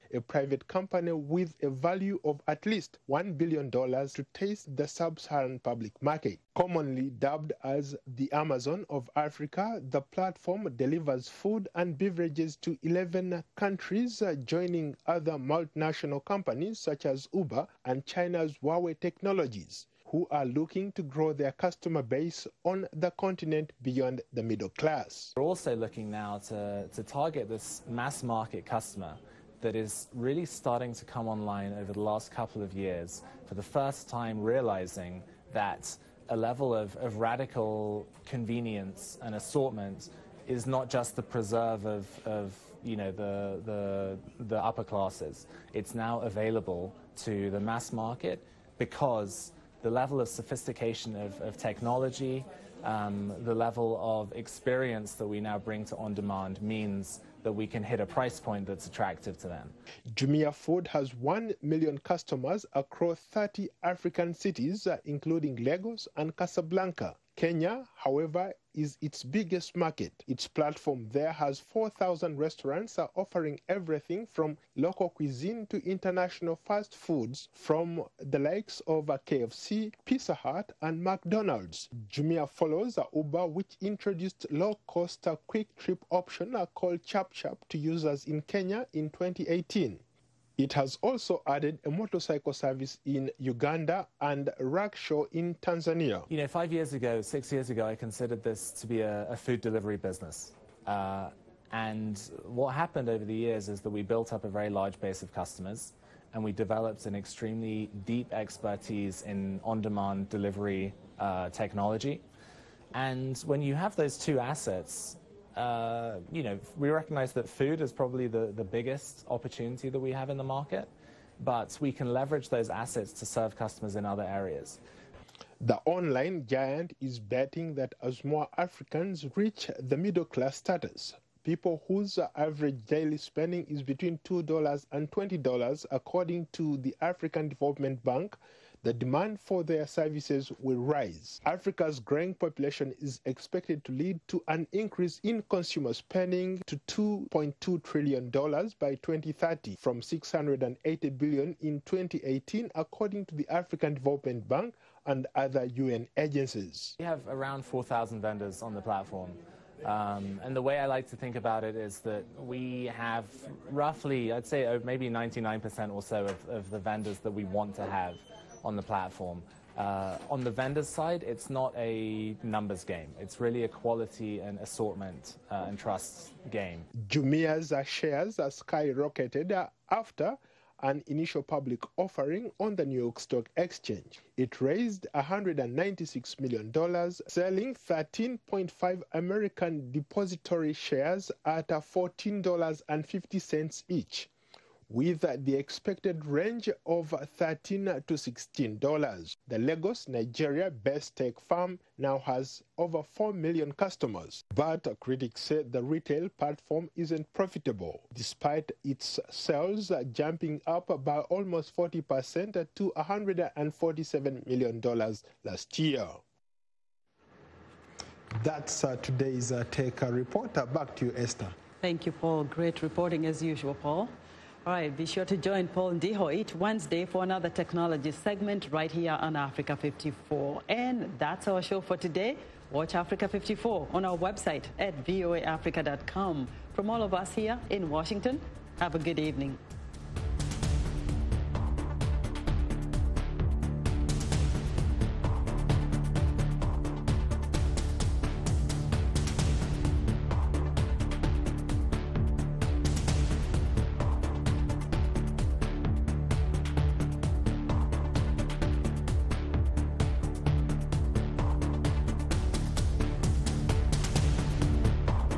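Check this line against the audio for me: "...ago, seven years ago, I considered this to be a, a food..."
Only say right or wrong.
wrong.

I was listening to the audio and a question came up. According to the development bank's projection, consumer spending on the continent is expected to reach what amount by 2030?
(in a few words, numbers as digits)
$2.2 trillion.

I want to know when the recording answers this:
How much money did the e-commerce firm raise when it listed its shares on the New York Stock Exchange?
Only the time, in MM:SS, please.
03:05.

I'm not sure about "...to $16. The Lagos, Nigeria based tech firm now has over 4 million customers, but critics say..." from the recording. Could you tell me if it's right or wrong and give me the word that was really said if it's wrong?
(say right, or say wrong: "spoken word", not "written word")
right.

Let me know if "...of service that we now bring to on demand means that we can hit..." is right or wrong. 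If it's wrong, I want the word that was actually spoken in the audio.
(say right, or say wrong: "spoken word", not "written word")
wrong: "experience", not "service".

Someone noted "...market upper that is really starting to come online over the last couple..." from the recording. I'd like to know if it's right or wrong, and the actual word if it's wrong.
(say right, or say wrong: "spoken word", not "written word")
wrong: "customer", not "upper".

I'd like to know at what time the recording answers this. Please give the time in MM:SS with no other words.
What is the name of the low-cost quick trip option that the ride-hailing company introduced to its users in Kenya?
01:27.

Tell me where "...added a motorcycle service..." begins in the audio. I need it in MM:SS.
01:31.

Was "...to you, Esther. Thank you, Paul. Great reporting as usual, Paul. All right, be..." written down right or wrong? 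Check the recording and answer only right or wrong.
right.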